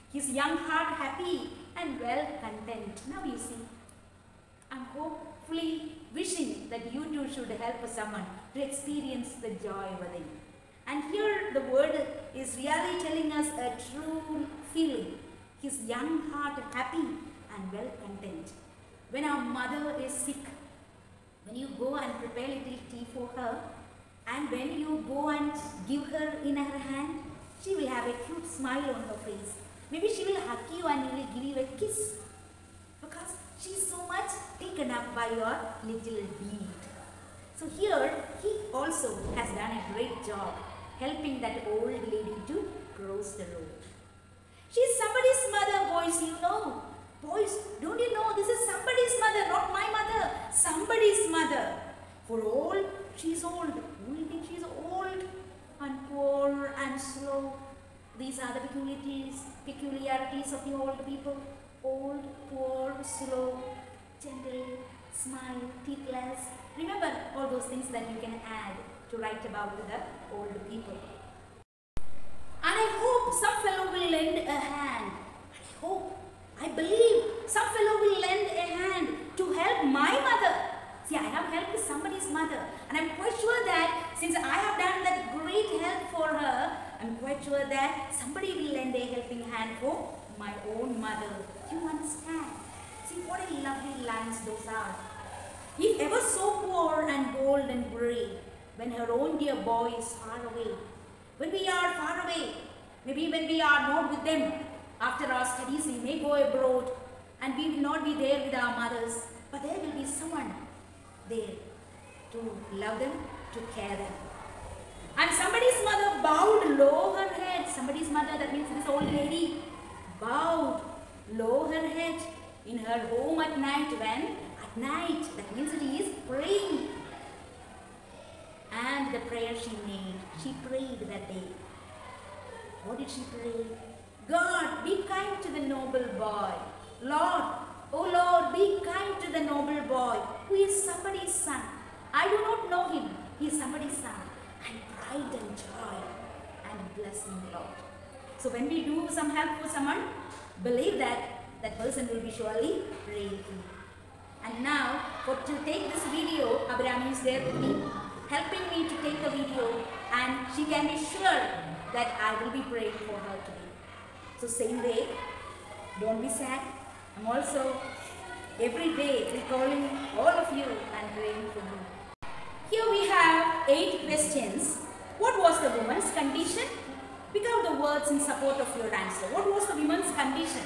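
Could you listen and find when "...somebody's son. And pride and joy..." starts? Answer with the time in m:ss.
2:23.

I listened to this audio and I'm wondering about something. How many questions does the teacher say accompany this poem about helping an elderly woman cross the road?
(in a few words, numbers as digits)
8.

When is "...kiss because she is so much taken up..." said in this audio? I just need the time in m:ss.
0:31.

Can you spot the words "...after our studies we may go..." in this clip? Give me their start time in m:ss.
1:44.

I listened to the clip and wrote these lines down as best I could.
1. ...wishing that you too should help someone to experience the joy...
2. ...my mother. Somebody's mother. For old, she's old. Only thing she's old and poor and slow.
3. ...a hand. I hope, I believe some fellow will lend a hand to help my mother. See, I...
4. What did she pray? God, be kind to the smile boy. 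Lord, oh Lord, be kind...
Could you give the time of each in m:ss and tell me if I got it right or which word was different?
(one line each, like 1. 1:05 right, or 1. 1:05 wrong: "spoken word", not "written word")
1. 0:06 right
2. 0:49 right
3. 1:14 right
4. 2:12 wrong: "noble", not "smile".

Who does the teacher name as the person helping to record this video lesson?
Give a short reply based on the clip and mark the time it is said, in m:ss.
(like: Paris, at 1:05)
Abraham, at 2:36.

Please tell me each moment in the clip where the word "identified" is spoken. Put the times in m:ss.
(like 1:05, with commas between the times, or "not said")
not said.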